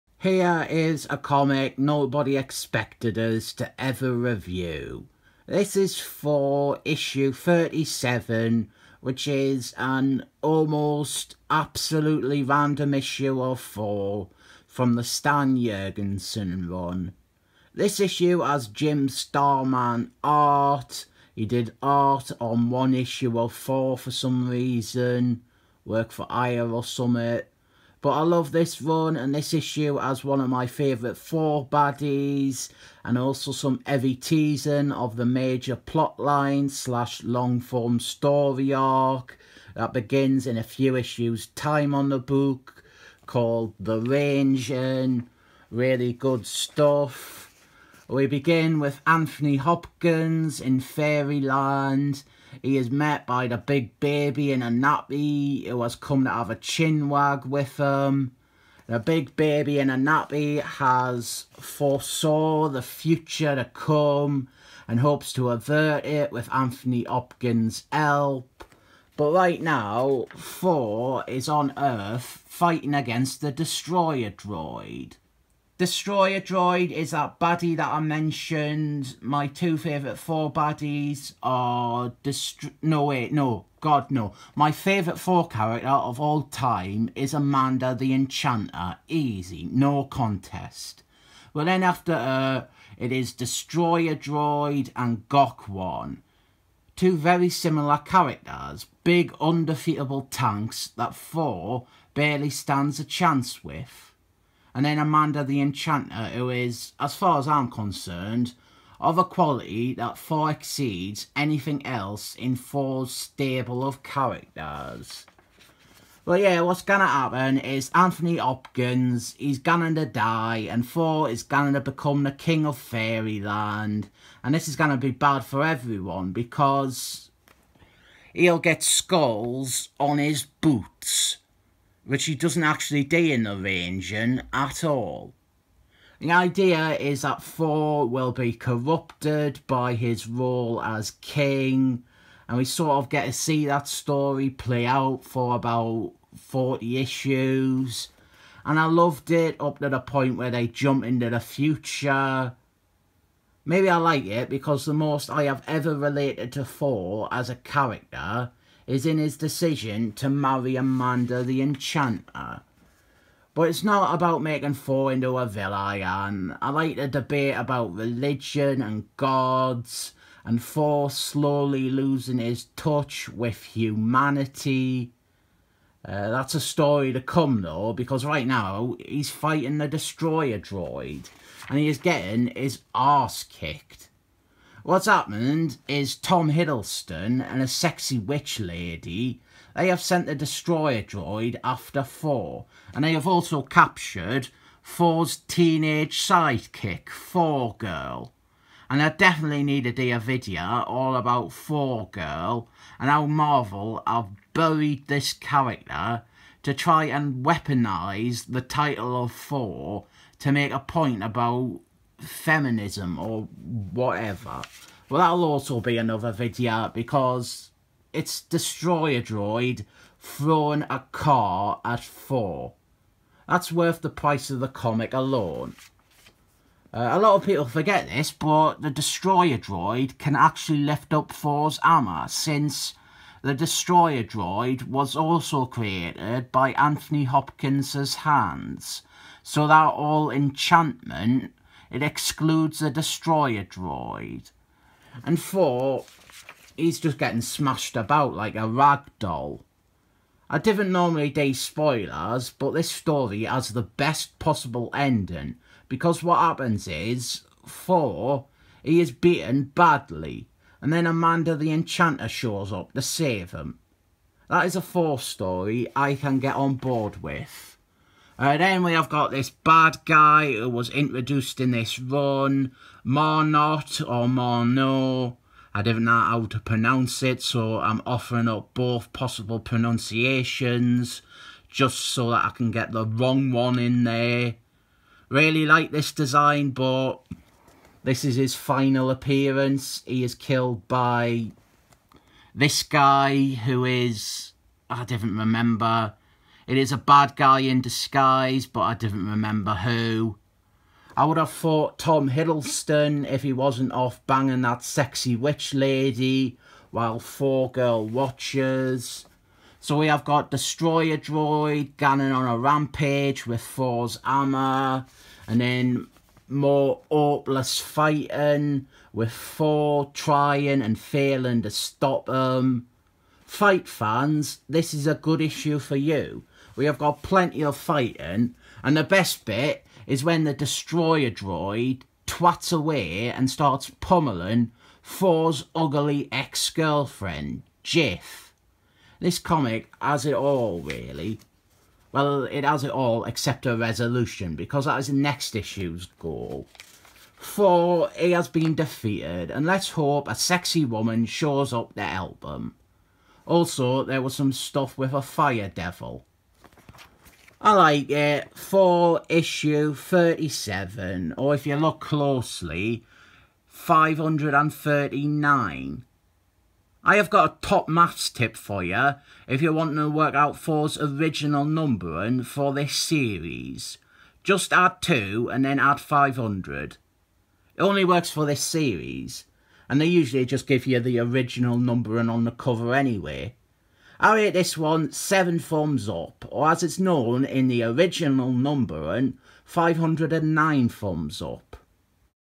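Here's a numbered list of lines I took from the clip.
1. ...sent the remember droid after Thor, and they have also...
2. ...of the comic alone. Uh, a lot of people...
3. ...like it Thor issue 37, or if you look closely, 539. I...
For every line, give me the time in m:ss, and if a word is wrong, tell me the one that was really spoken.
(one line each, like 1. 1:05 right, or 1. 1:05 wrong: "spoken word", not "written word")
1. 3:10 wrong: "destroyer", not "remember"
2. 3:44 right
3. 5:57 right.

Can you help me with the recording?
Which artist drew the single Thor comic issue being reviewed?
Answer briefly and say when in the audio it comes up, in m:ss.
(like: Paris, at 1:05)
Jim Starlin, at 0:18.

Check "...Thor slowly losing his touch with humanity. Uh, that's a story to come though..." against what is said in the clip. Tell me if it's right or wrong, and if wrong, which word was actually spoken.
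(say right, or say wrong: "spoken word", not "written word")
right.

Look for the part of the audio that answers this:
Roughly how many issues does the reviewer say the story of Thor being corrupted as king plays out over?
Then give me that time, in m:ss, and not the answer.
2:26.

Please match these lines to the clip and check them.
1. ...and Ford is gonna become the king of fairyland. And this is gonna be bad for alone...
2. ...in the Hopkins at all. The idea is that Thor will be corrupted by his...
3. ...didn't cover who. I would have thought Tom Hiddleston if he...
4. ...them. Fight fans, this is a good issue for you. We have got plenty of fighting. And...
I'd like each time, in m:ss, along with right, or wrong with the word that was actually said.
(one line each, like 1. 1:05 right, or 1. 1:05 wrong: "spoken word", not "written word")
1. 2:00 wrong: "everyone", not "alone"
2. 2:13 wrong: "Reigning", not "Hopkins"
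3. 4:58 wrong: "remember", not "cover"
4. 5:22 right.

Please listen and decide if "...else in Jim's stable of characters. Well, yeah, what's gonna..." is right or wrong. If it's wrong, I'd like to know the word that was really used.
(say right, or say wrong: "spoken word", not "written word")
wrong: "Thor", not "Jim".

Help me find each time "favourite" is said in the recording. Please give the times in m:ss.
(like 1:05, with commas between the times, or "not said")
0:30, 1:19, 1:24.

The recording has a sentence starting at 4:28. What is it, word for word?
Uh, then we have got this bad guy who was introduced in this run, Marnot or Marno.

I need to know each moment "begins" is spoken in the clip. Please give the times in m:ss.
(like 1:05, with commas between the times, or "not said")
0:39, 0:48.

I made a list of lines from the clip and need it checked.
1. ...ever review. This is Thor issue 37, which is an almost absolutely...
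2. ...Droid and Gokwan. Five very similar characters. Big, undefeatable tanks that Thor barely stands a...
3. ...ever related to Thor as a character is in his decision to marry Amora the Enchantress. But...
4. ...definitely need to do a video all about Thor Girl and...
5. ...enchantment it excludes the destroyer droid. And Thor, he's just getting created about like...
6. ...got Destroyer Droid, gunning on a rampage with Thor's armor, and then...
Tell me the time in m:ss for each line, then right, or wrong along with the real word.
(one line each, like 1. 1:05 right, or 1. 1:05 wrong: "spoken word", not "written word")
1. 0:03 right
2. 1:34 wrong: "Two", not "Five"
3. 2:35 right
4. 3:19 right
5. 4:00 wrong: "smashed", not "created"
6. 5:10 right.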